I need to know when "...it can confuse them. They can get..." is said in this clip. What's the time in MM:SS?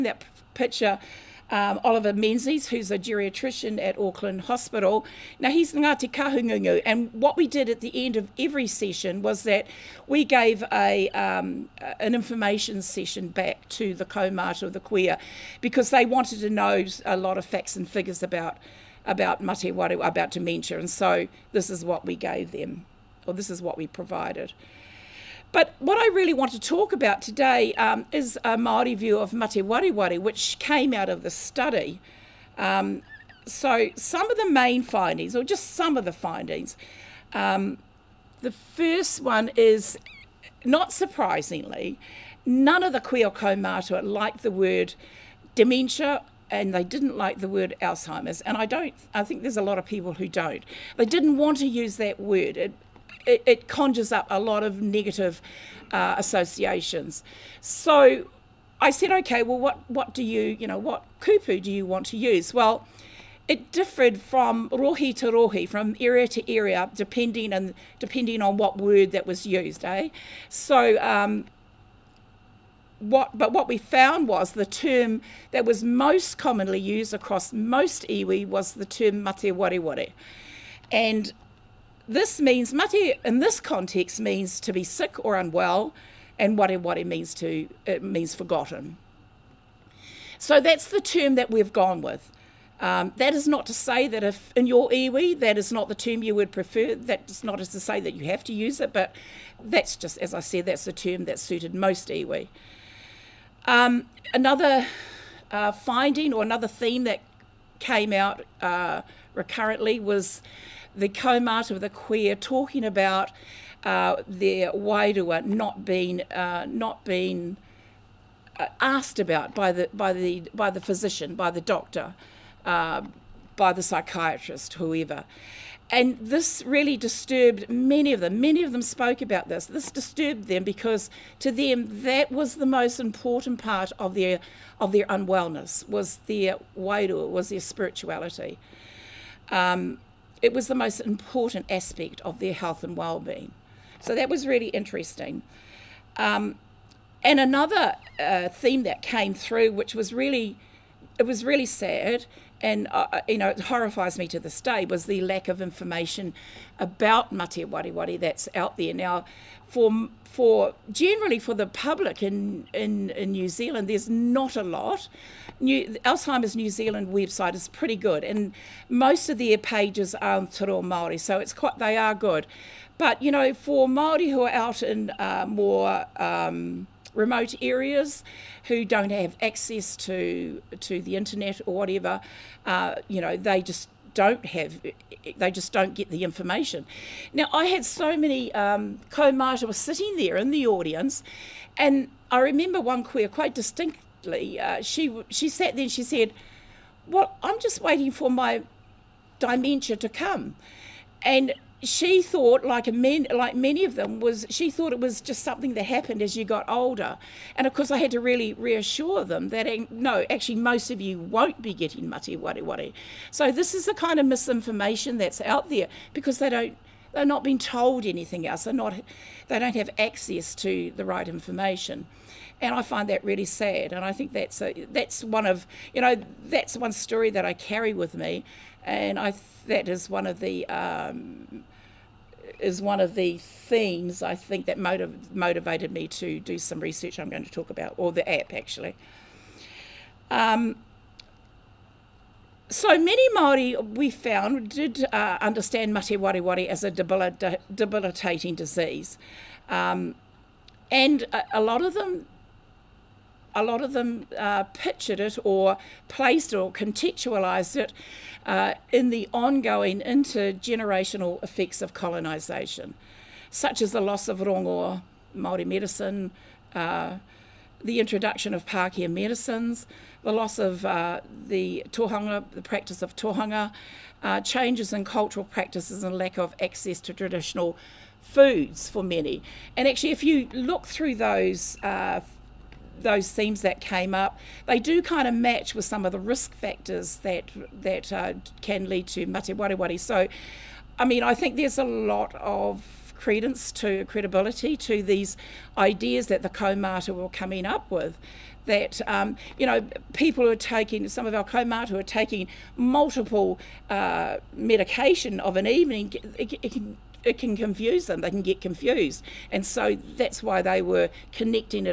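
05:07.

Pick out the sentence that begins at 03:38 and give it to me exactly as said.
They're not they don't have access to the right information, and I find that really sad.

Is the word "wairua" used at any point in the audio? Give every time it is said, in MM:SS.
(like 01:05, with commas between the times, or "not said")
01:54, 02:16.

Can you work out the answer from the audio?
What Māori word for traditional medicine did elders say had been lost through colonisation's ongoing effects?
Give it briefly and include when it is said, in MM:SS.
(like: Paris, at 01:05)
rongoa, at 04:24.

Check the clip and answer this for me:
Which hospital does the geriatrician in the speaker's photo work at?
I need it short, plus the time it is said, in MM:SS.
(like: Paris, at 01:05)
Auckland Hospital, at 00:03.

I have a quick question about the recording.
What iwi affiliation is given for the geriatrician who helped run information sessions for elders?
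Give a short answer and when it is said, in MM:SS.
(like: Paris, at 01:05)
Ngāti Kahungunu, at 00:05.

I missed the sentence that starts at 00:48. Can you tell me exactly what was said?
And I don't, I think there's a lot of people who don't.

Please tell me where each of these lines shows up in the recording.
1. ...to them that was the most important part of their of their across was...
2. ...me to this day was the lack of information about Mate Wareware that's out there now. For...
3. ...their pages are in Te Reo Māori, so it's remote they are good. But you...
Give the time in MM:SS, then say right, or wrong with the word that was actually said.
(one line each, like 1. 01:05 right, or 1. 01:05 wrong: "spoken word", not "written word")
1. 02:11 wrong: "unwellness", not "across"
2. 02:34 right
3. 02:49 wrong: "quite", not "remote".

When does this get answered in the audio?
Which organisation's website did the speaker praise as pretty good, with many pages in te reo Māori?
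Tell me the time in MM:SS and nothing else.
02:46.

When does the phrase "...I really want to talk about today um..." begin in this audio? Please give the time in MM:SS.
00:25.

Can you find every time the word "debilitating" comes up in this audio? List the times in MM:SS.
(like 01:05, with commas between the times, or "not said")
04:06.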